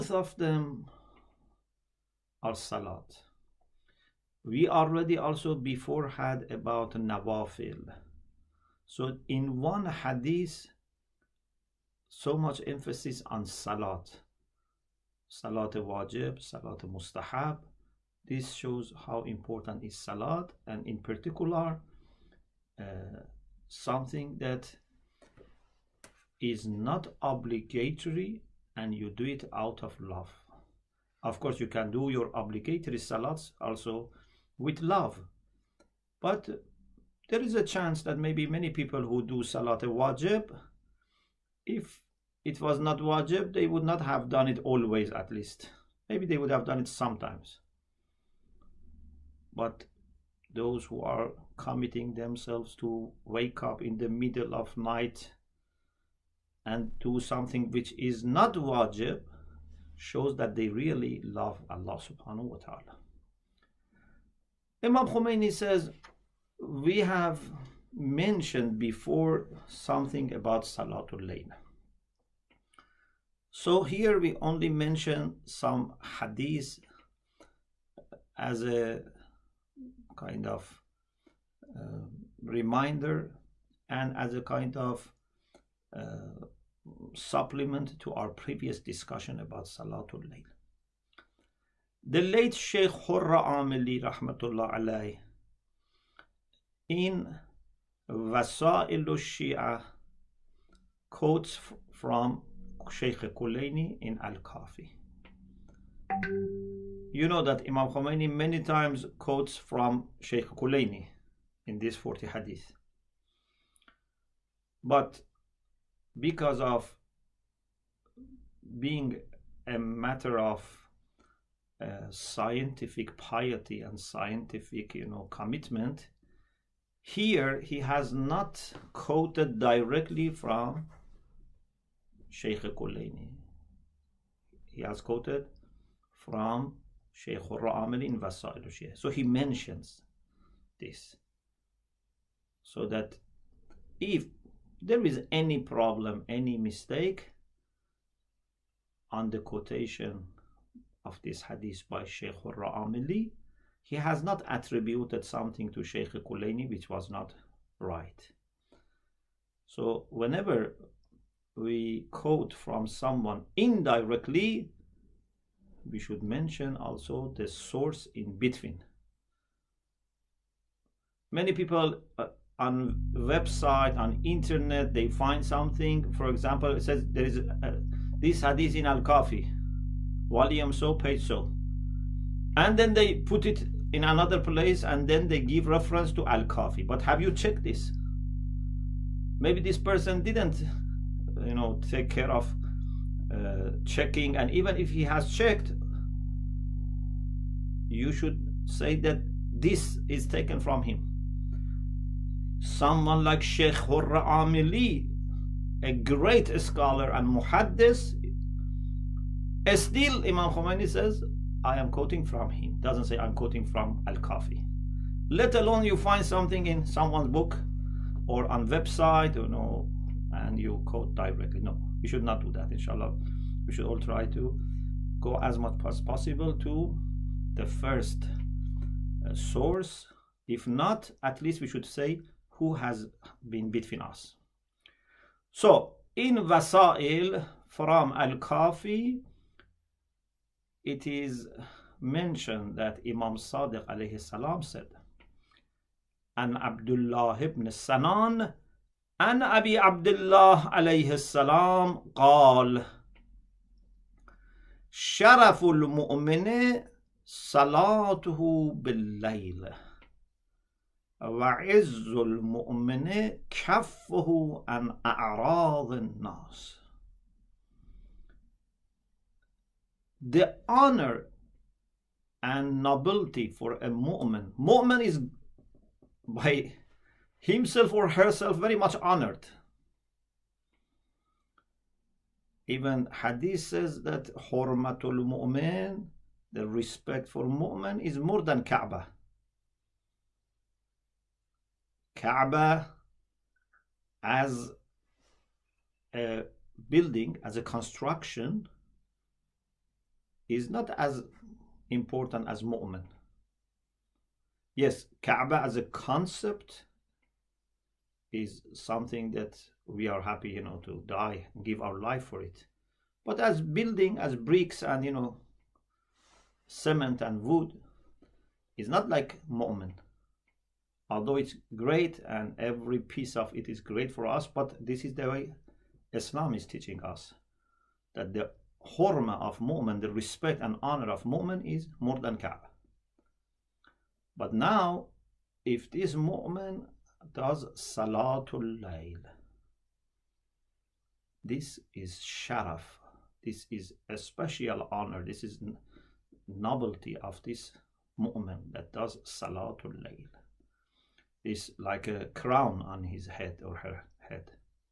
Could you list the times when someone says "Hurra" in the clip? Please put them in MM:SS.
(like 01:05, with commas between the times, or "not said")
01:32, 03:23.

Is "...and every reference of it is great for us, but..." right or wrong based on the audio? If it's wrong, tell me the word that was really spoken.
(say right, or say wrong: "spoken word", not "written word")
wrong: "piece", not "reference".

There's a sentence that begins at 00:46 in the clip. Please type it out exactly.
Maybe they would have done it sometimes.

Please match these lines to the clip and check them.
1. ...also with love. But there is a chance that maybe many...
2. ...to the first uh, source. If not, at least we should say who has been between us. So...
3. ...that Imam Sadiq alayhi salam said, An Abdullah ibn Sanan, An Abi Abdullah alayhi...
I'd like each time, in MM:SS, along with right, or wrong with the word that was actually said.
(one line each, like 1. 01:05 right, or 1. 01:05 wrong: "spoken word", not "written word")
1. 00:33 right
2. 03:46 right
3. 04:02 right.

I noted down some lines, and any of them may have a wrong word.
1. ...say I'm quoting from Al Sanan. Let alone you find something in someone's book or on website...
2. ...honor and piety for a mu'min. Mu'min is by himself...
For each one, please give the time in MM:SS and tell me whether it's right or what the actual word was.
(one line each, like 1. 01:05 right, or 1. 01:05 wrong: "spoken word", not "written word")
1. 03:33 wrong: "Kafi", not "Sanan"
2. 04:30 wrong: "nobility", not "piety".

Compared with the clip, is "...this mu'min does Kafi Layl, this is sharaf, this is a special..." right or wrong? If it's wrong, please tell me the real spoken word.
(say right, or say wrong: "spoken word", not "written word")
wrong: "Salatul", not "Kafi".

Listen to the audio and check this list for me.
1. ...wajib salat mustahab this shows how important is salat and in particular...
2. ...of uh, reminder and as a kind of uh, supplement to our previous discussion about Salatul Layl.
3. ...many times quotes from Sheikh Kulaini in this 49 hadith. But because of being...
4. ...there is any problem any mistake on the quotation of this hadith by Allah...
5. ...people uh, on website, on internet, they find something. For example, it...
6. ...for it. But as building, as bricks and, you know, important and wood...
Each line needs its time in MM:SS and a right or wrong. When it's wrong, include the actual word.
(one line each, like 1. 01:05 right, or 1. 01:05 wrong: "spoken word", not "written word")
1. 00:15 right
2. 01:20 right
3. 01:48 wrong: "40", not "49"
4. 02:24 wrong: "Sheikh", not "Allah"
5. 02:51 right
6. 05:12 wrong: "cement", not "important".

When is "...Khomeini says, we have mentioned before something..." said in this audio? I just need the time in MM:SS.
01:05.